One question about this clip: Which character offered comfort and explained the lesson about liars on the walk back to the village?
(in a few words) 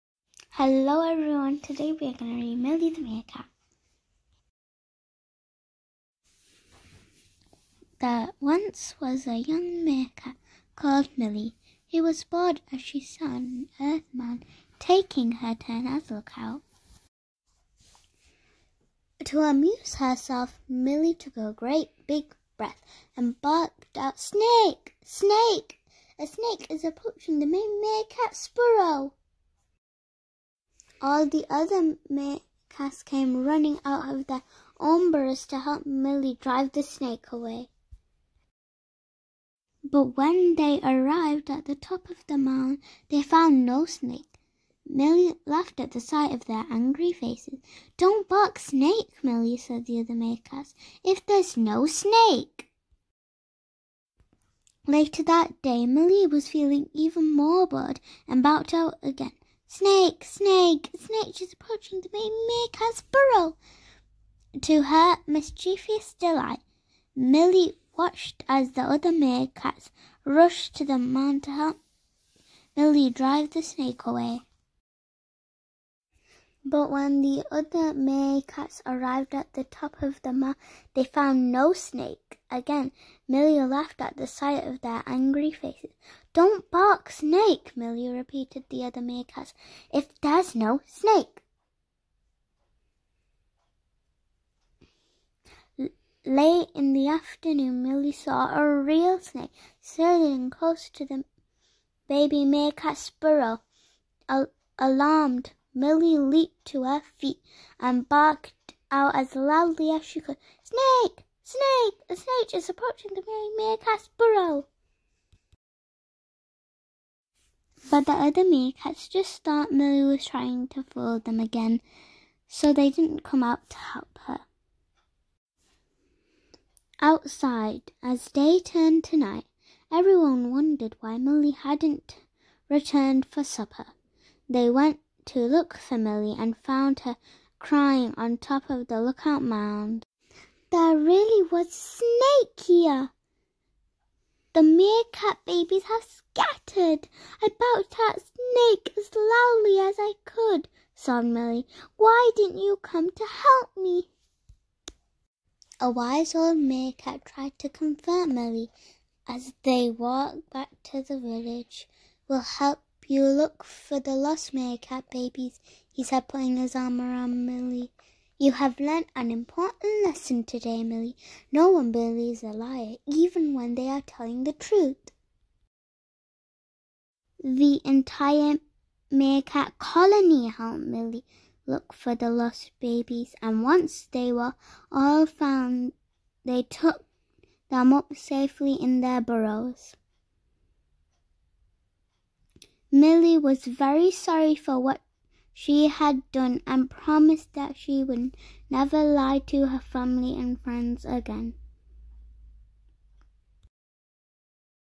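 A wise old meerkat.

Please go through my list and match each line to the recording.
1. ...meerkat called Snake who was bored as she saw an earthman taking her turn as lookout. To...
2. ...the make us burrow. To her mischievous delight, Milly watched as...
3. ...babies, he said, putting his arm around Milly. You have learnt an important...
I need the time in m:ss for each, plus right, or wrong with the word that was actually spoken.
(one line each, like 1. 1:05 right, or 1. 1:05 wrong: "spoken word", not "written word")
1. 0:09 wrong: "Milly", not "Snake"
2. 1:02 right
3. 2:45 right.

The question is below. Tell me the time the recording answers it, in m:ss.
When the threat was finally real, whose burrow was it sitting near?
1:42.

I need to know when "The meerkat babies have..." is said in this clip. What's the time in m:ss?
2:24.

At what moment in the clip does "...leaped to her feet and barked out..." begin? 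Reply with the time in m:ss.
1:46.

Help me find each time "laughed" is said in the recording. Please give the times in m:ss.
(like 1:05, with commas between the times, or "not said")
0:45, 1:23.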